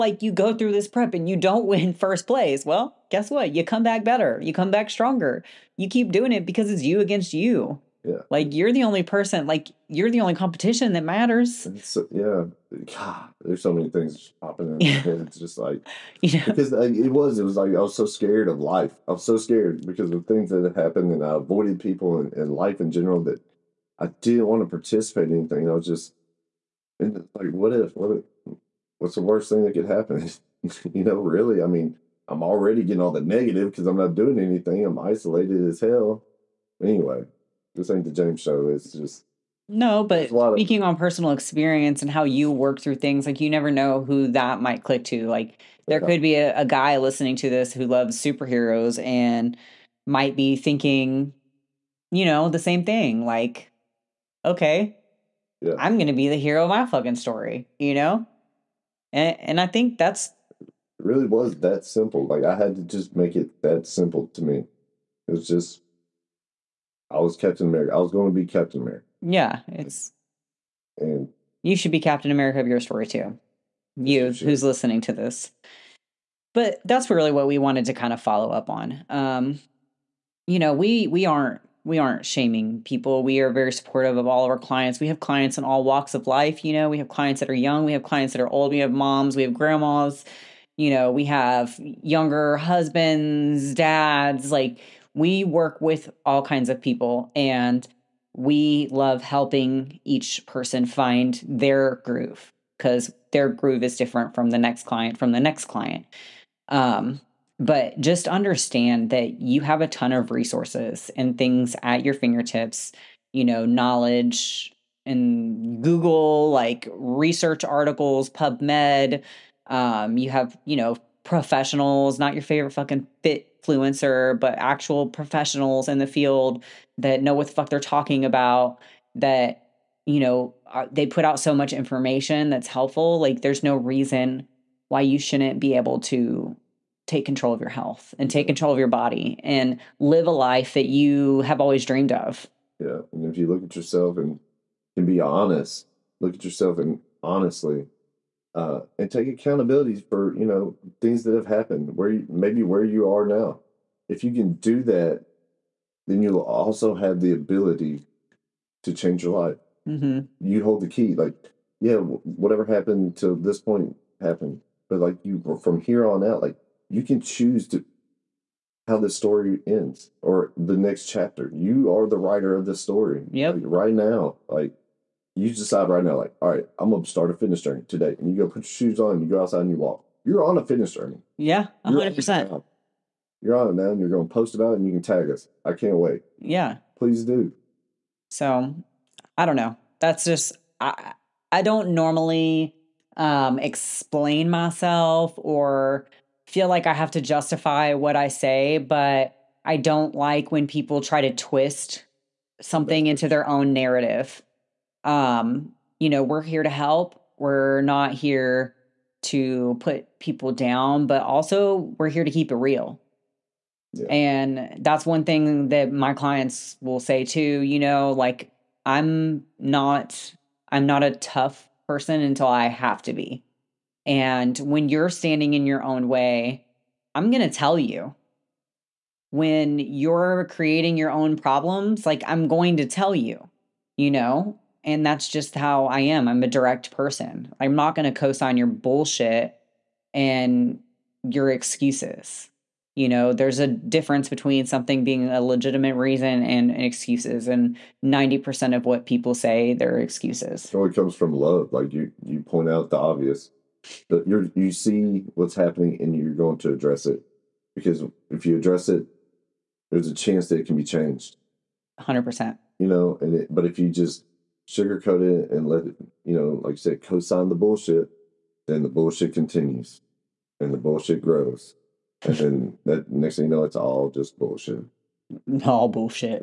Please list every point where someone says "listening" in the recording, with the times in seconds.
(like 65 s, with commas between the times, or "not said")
46 s, 74 s.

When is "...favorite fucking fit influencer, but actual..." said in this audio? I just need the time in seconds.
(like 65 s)
122 s.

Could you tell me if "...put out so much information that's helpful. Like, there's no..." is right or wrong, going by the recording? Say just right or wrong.
right.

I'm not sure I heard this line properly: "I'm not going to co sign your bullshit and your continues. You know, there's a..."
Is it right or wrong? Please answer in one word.
wrong.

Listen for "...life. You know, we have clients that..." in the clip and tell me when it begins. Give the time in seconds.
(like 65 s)
86 s.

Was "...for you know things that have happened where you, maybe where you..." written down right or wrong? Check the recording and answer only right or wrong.
right.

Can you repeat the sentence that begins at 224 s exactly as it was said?
And when you're standing in your own way, I'm going to tell you.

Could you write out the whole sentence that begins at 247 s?
And 90% of what people say, they're excuses.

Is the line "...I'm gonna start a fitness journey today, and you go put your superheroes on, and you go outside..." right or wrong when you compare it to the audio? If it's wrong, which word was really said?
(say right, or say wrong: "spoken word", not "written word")
wrong: "shoes", not "superheroes".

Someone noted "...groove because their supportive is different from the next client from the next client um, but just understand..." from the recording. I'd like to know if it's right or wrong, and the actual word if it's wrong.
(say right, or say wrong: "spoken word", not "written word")
wrong: "groove", not "supportive".